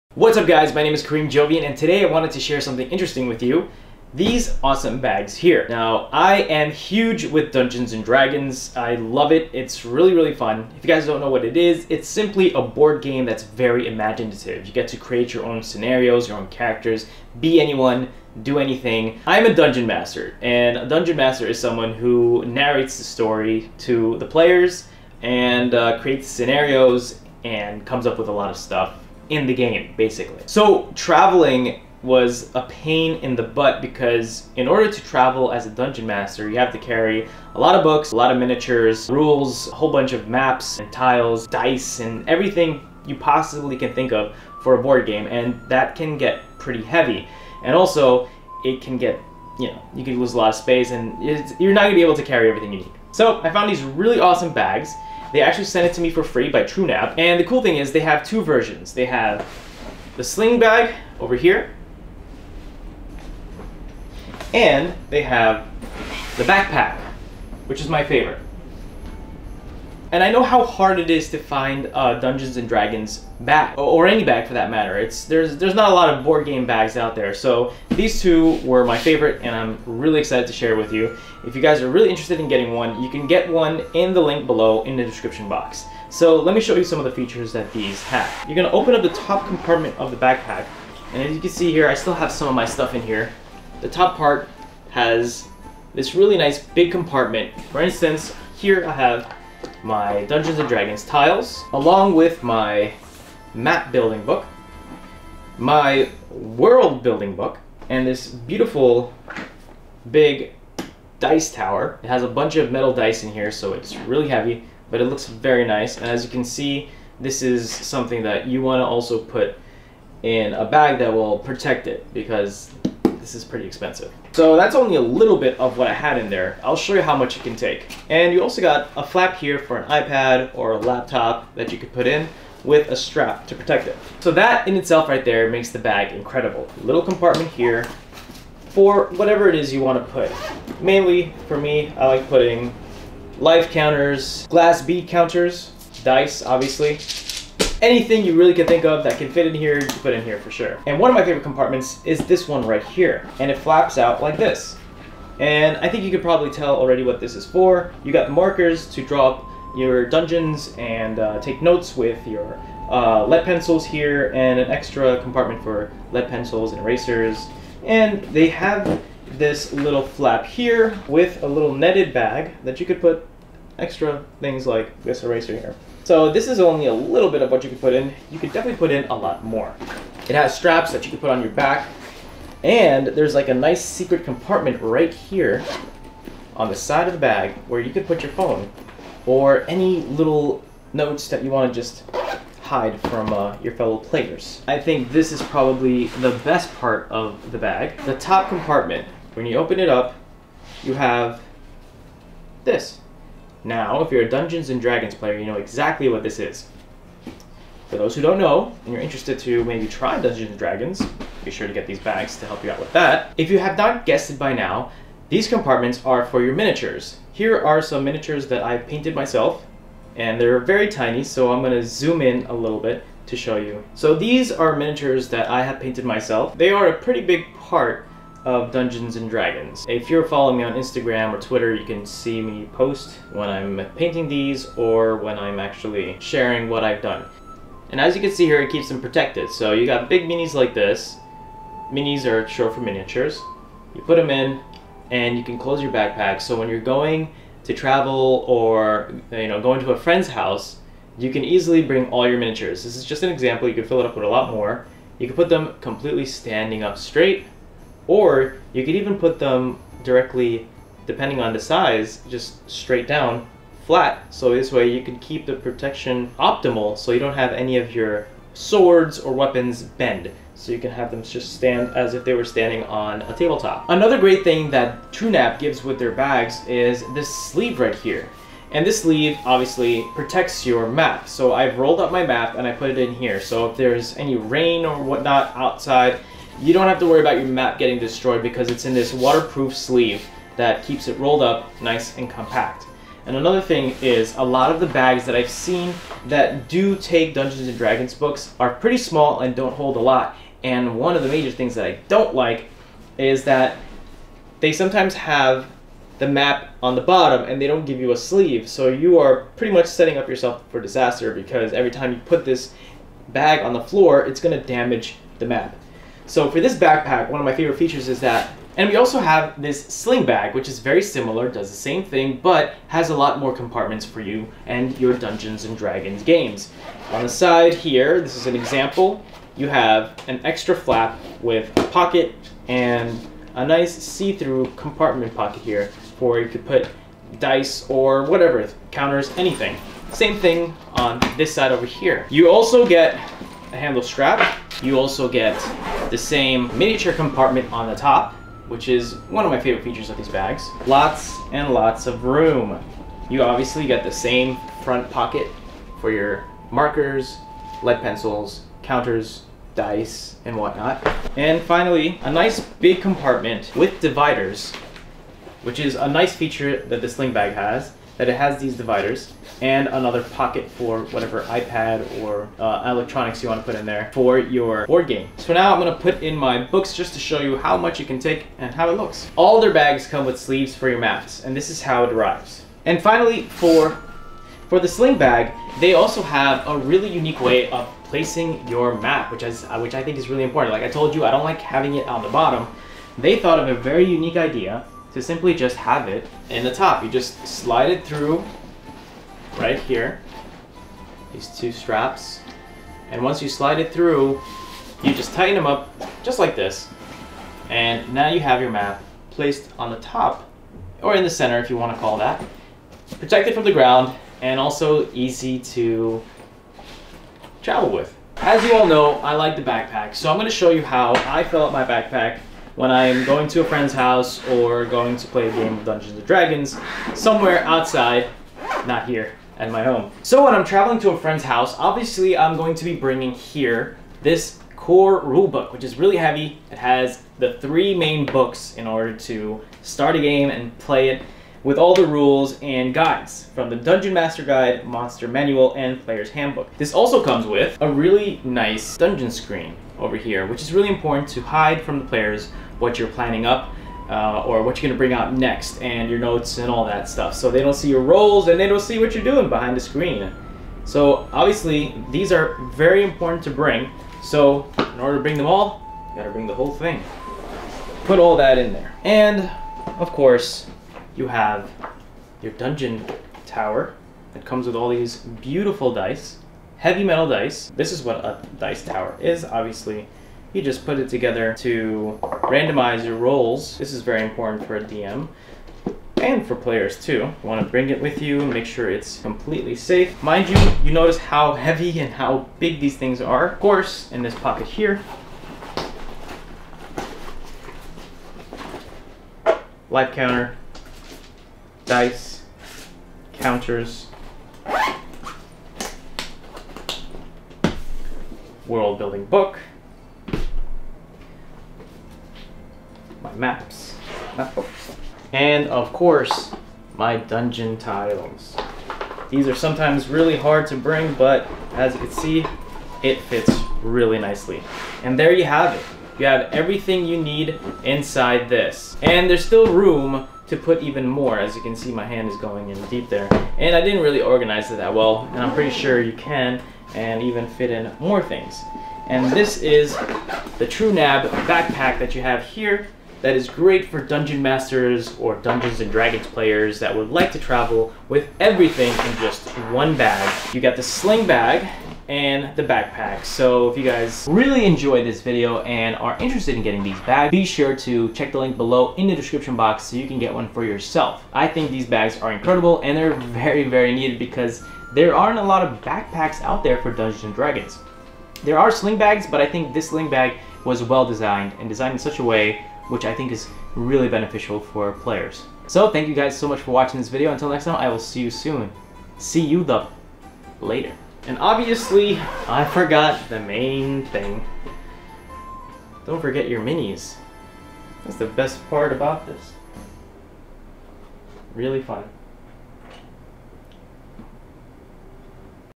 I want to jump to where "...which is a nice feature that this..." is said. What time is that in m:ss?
6:05.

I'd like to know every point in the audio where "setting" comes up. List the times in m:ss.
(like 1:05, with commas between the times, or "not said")
5:09.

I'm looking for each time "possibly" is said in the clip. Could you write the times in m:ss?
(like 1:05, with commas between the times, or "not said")
0:43.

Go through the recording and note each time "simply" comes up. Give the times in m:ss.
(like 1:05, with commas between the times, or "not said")
0:12, 6:35.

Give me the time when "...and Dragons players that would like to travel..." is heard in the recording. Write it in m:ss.
9:05.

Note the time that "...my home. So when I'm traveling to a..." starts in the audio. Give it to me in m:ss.
7:09.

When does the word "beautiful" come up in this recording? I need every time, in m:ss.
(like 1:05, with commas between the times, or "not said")
1:48, 7:55.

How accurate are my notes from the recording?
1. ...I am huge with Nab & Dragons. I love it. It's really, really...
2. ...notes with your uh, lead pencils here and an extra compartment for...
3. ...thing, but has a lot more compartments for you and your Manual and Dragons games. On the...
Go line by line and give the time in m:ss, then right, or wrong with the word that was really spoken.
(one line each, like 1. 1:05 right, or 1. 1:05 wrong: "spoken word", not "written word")
1. 0:06 wrong: "Dungeons", not "Nab"
2. 2:41 right
3. 5:22 wrong: "Dungeons", not "Manual".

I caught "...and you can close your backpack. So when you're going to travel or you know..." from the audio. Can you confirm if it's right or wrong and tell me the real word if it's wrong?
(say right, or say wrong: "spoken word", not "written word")
right.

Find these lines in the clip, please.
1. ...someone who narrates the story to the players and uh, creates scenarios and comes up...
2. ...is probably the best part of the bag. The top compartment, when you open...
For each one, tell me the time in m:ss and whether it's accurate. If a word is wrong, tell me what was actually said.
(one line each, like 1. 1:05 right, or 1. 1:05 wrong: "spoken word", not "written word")
1. 0:21 right
2. 3:15 right.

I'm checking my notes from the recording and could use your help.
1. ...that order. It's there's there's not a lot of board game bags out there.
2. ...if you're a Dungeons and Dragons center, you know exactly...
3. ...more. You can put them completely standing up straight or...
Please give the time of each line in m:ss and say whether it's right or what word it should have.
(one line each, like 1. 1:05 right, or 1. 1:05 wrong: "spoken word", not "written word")
1. 1:14 wrong: "matter", not "order"
2. 3:24 wrong: "player", not "center"
3. 4:14 right.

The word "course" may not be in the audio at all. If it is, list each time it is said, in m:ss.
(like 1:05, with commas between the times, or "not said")
7:50, 8:13, 8:35.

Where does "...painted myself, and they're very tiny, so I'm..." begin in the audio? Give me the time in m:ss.
3:38.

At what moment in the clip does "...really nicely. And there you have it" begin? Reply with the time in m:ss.
8:43.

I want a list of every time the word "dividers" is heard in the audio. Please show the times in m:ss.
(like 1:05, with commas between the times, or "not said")
6:04, 6:08.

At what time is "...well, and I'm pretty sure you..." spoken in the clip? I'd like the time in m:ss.
8:54.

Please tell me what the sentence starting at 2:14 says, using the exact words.
So that in itself right there makes the bag incredible.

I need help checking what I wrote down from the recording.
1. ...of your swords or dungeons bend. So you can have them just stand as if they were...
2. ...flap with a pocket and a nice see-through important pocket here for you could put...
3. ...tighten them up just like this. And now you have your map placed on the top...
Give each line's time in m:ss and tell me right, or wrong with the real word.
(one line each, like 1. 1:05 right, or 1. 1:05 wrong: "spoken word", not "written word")
1. 4:27 wrong: "weapons", not "dungeons"
2. 5:30 wrong: "compartment", not "important"
3. 6:45 right.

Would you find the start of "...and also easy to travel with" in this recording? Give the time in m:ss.
6:54.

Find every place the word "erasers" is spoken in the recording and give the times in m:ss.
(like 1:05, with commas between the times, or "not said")
2:46, 2:55.